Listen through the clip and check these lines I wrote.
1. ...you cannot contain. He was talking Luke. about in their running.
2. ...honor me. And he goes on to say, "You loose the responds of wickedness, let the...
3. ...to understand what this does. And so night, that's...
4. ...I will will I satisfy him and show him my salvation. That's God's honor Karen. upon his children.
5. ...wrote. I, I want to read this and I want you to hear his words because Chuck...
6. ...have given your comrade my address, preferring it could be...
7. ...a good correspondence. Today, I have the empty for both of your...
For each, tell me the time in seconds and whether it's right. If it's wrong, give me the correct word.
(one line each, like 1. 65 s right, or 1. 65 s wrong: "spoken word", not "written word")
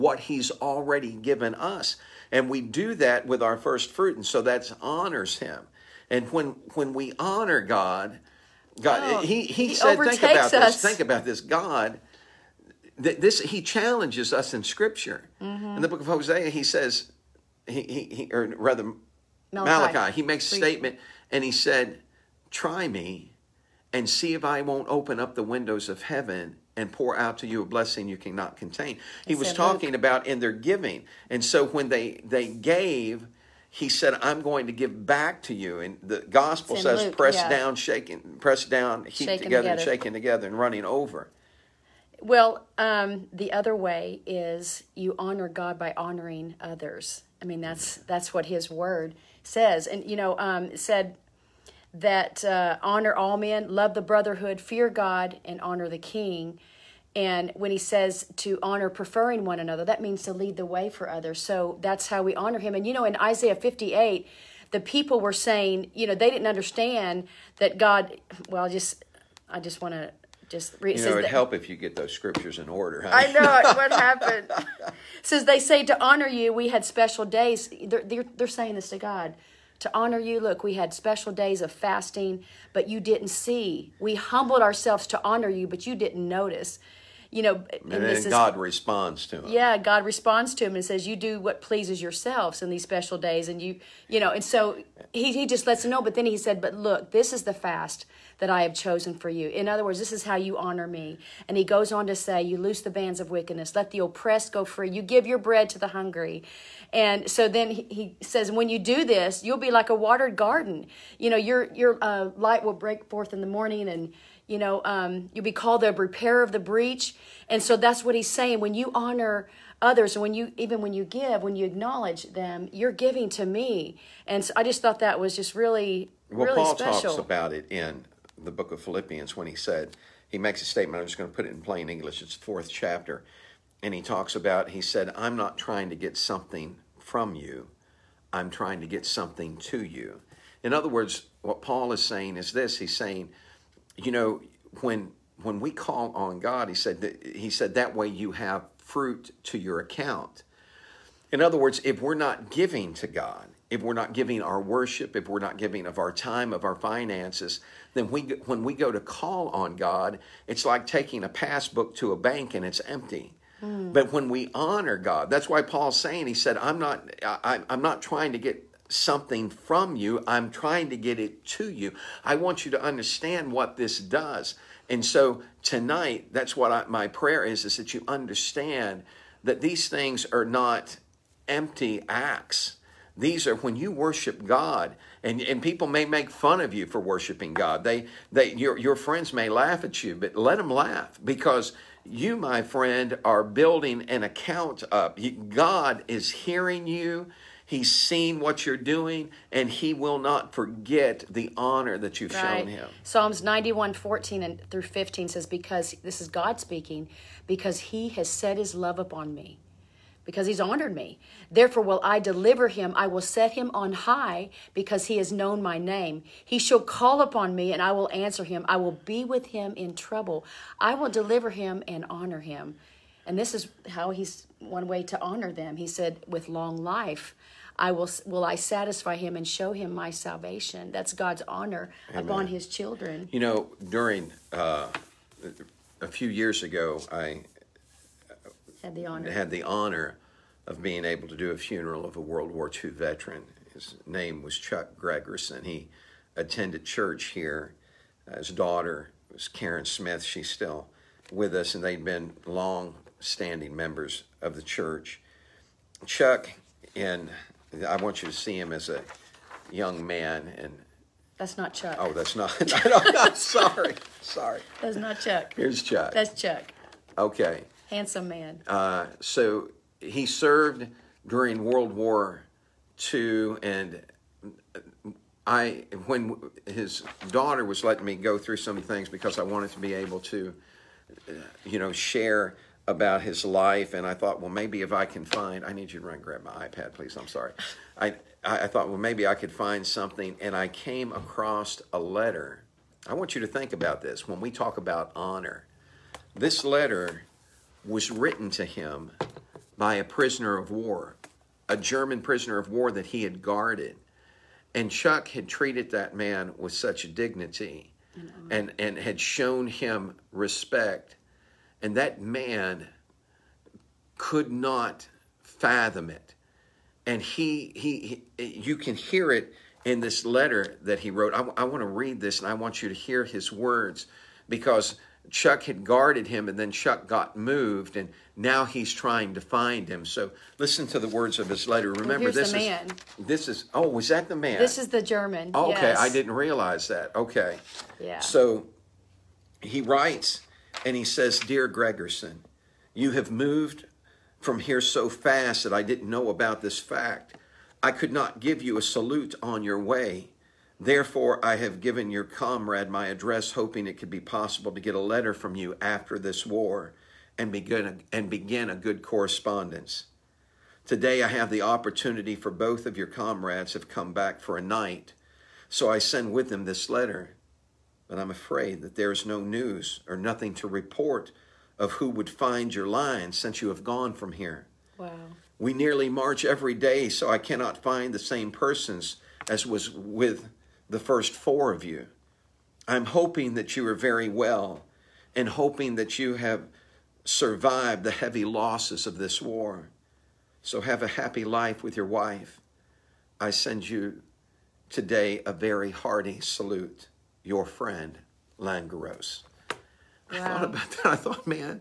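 1. 28 s wrong: "giving", not "running"
2. 100 s wrong: "bands", not "responds"
3. 172 s wrong: "tonight", not "night"
4. 227 s wrong: "Amen", not "Karen"
5. 321 s right
6. 351 s wrong: "hoping", not "preferring"
7. 358 s wrong: "opportunity", not "empty".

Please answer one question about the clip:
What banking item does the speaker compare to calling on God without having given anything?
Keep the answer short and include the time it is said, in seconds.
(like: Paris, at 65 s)
Passbook, at 161 s.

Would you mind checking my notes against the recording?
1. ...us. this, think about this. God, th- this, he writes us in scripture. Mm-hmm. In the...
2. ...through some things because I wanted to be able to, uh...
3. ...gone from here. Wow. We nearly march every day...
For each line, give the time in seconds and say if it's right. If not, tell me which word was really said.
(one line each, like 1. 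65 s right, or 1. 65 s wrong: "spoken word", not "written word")
1. 10 s wrong: "challenges", not "writes"
2. 278 s right
3. 373 s right.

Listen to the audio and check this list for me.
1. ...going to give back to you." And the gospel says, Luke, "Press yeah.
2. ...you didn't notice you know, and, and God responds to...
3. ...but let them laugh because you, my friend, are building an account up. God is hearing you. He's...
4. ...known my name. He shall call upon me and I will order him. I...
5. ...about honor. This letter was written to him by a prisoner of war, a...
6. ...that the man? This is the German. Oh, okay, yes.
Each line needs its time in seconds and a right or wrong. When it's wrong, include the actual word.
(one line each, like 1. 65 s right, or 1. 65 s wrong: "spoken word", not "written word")
1. 34 s right
2. 85 s right
3. 190 s right
4. 215 s wrong: "answer", not "order"
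5. 294 s right
6. 334 s right.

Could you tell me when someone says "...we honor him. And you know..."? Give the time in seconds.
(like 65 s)
62 s.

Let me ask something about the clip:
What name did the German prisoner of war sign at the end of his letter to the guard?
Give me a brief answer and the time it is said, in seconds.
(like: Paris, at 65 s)
Langaros, at 398 s.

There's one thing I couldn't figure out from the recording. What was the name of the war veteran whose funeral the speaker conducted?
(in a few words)
Chuck Gregerson.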